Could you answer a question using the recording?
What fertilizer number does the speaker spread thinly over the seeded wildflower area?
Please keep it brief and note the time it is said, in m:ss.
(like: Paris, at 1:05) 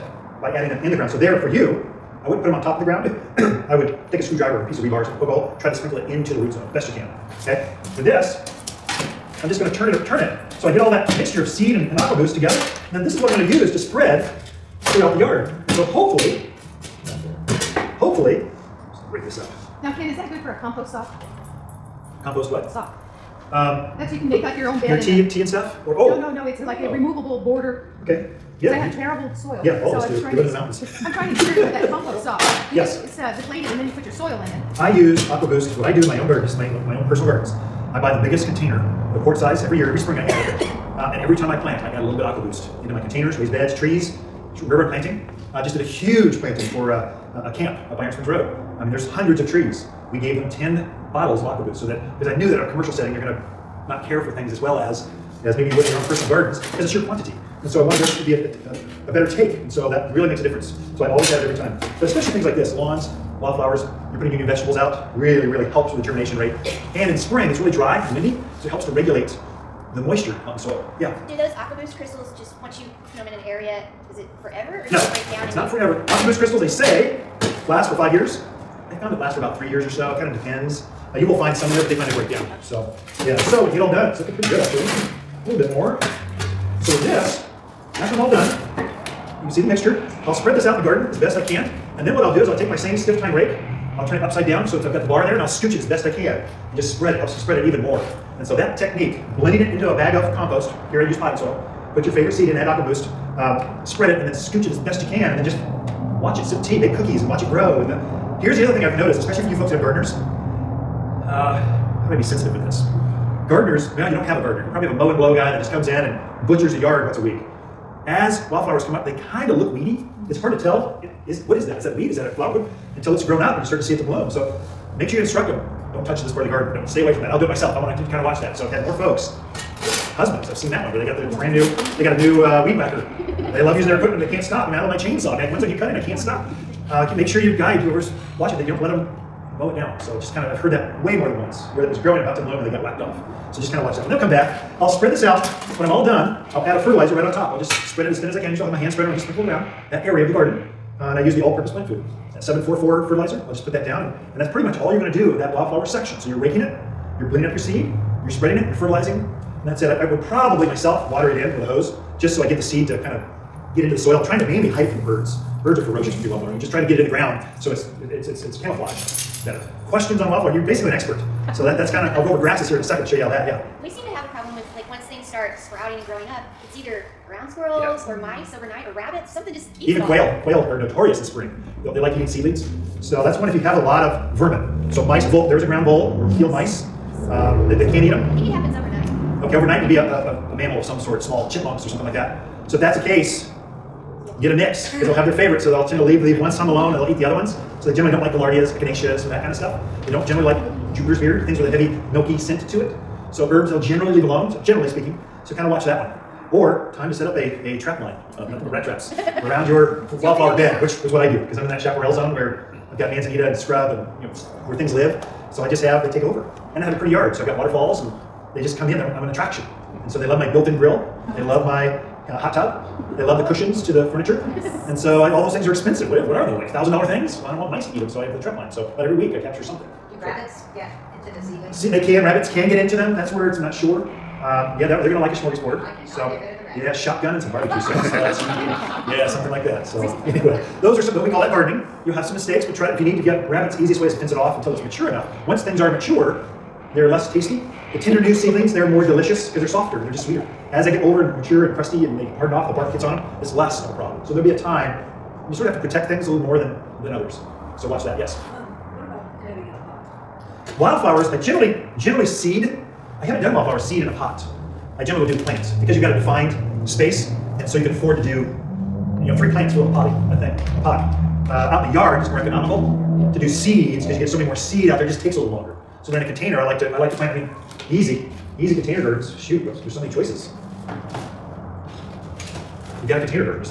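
744, at 2:32.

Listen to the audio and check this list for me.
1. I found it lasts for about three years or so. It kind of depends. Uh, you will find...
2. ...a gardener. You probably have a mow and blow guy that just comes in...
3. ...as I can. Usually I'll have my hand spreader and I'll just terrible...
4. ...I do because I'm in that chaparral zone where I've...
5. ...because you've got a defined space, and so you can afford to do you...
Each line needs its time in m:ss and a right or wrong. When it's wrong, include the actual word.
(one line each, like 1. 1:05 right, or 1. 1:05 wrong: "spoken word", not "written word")
1. 1:18 right
2. 1:54 right
3. 2:28 wrong: "sprinkle", not "terrible"
4. 3:31 right
5. 4:25 right.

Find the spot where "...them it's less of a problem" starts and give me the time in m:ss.
4:13.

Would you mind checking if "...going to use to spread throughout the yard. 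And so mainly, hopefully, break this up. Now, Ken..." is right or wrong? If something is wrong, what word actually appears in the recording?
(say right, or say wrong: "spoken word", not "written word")
wrong: "hopefully", not "mainly".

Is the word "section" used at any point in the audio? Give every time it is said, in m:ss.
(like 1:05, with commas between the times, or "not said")
2:35.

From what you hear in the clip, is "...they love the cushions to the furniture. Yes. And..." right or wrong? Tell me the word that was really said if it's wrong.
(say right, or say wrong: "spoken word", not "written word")
right.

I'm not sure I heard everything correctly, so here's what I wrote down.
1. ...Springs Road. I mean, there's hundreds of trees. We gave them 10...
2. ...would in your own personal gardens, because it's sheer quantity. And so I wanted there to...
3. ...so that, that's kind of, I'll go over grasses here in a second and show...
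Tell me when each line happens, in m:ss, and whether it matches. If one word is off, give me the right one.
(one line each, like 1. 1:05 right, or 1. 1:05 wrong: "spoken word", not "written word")
1. 0:48 right
2. 0:55 right
3. 2:51 right.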